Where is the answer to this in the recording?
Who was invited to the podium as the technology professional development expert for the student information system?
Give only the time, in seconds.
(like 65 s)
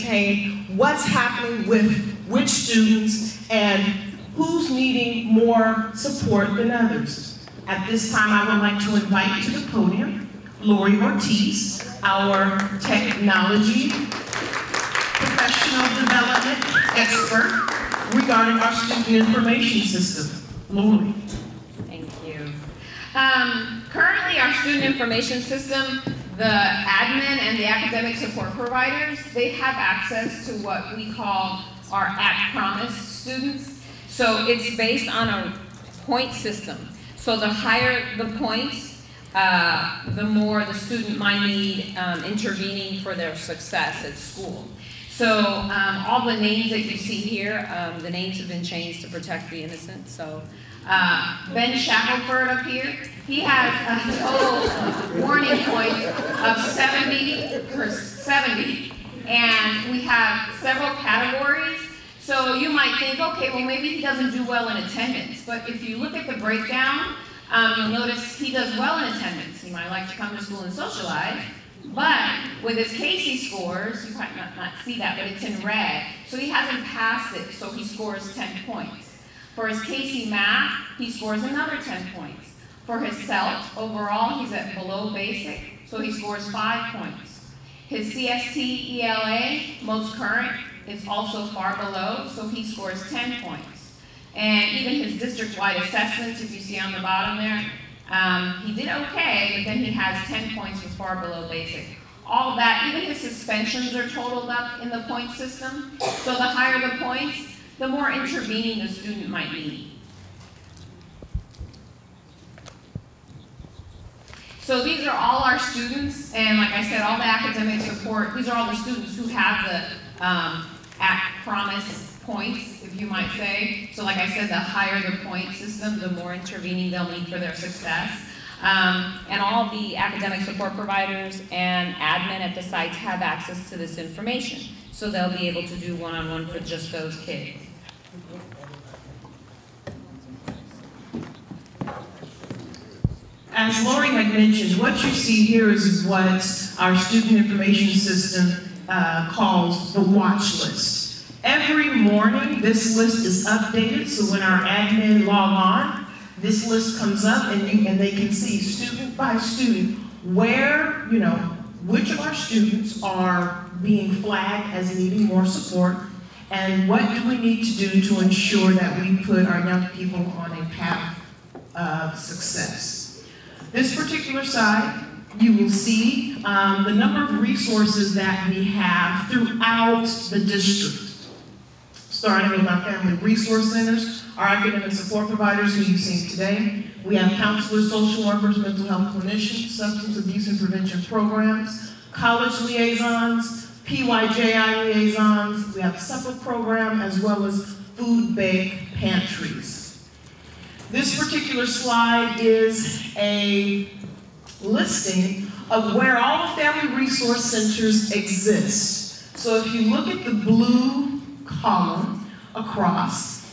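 10 s.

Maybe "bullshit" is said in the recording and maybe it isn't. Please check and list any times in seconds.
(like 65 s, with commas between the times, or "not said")
not said.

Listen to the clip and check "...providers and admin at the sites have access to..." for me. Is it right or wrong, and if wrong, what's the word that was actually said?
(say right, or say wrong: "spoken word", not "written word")
right.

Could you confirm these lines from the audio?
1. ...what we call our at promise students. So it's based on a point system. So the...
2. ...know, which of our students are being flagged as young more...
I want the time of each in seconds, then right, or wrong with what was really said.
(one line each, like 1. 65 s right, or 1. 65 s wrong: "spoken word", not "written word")
1. 30 s right
2. 161 s wrong: "needing", not "young".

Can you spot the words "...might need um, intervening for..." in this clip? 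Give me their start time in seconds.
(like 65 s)
41 s.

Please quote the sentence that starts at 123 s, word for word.
So like I said, the higher the point system, the more intervening they'll need for their success.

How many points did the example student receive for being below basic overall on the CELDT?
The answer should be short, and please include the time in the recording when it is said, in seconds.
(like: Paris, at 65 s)
5, at 86 s.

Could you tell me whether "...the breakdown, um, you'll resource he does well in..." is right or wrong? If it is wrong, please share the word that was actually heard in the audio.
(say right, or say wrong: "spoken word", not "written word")
wrong: "notice", not "resource".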